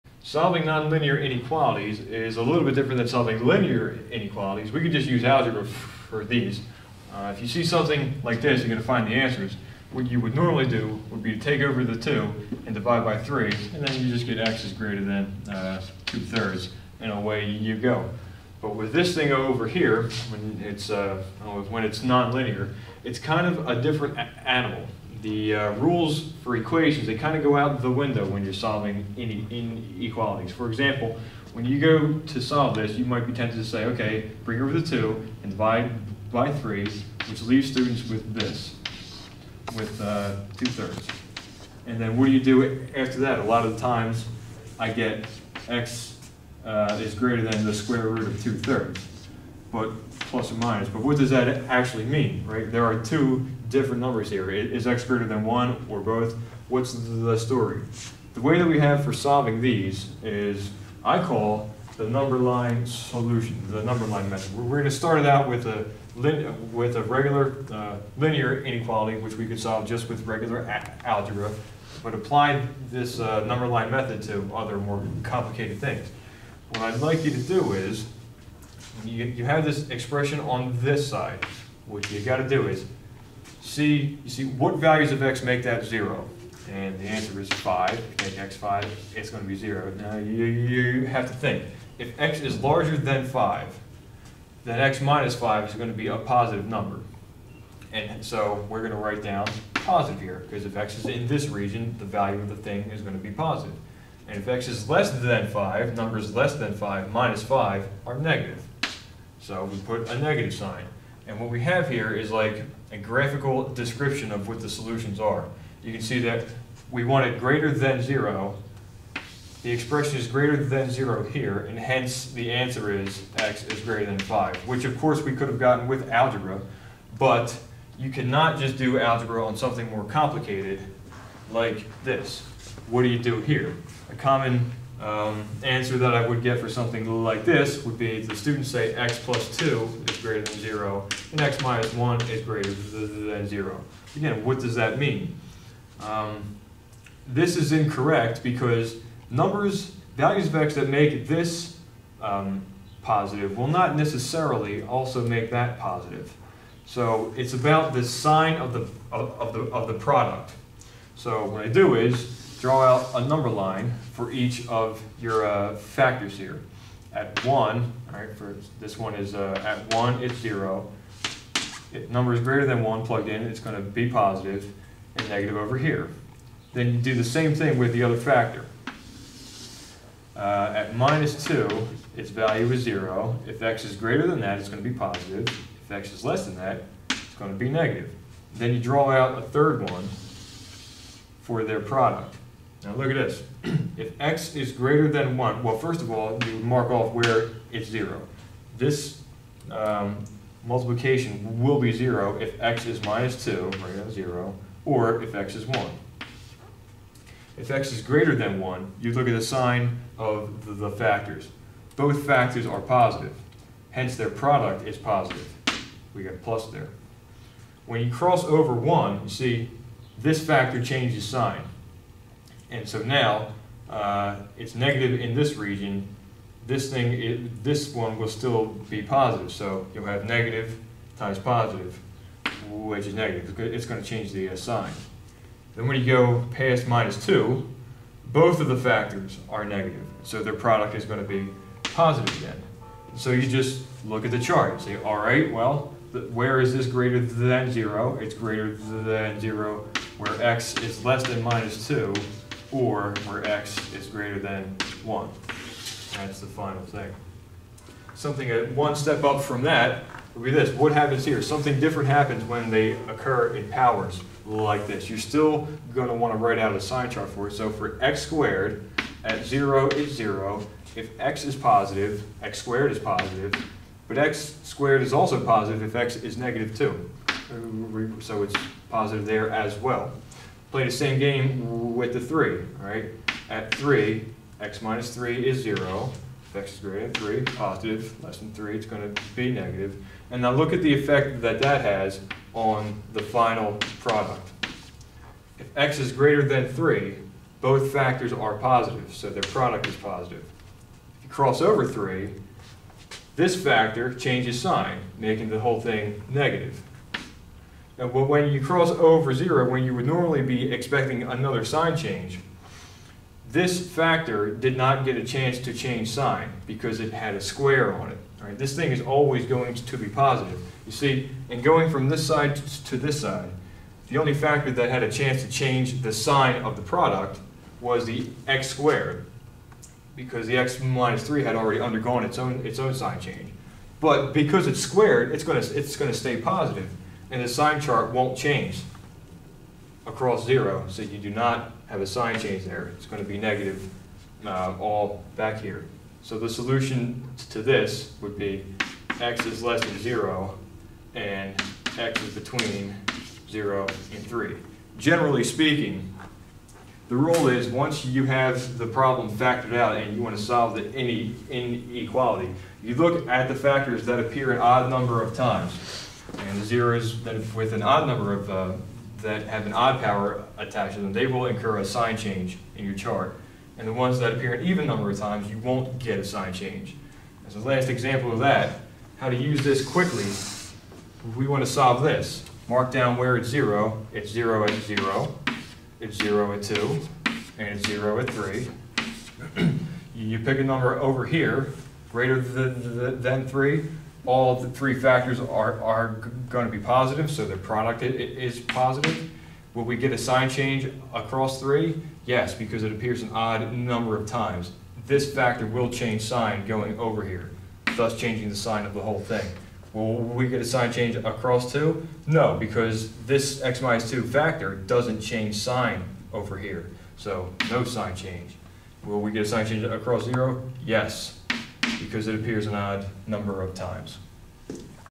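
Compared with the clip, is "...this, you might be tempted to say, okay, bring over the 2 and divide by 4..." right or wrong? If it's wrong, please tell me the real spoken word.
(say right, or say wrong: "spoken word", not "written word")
wrong: "3", not "4".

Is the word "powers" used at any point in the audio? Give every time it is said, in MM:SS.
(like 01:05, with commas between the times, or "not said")
04:23, 06:10.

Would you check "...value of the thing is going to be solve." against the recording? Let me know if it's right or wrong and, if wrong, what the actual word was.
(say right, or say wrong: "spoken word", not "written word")
wrong: "positive", not "solve".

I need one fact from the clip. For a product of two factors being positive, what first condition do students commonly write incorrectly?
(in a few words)
x + 2 > 0.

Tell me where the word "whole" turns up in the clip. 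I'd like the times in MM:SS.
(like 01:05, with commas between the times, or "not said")
05:05, 06:49.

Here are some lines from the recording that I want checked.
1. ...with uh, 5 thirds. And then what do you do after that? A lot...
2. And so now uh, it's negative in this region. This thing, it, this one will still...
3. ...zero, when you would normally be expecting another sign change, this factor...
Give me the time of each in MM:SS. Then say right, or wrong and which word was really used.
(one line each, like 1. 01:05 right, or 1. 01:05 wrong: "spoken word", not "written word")
1. 00:39 wrong: "2", not "5"
2. 03:42 right
3. 05:09 right.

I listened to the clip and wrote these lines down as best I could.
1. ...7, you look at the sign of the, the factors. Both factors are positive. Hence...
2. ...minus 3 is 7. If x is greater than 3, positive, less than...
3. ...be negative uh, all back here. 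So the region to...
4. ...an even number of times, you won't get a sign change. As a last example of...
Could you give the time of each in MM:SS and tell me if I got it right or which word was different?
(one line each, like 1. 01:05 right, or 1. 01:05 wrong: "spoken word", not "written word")
1. 03:28 wrong: "1", not "7"
2. 04:44 wrong: "0", not "7"
3. 05:43 wrong: "solution", not "region"
4. 06:14 right.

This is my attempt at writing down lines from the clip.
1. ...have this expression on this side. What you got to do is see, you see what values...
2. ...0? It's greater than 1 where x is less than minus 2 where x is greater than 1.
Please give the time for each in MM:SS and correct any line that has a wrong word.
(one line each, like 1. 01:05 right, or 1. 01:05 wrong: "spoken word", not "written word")
1. 01:19 right
2. 04:07 wrong: "0", not "1".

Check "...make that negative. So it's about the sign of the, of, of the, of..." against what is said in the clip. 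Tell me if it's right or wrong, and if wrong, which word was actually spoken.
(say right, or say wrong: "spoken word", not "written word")
wrong: "positive", not "negative".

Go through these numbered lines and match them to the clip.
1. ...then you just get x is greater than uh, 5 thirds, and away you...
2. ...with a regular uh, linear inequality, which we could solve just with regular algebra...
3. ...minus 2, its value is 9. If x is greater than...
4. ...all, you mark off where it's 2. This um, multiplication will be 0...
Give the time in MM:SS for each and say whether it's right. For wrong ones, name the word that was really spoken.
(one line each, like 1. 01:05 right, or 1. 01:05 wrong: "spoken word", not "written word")
1. 00:13 wrong: "2", not "5"
2. 01:06 right
3. 03:00 wrong: "0", not "9"
4. 03:16 wrong: "0", not "2".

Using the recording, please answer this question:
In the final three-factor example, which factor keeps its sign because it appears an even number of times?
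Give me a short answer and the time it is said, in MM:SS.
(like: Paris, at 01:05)
x - 2, at 06:53.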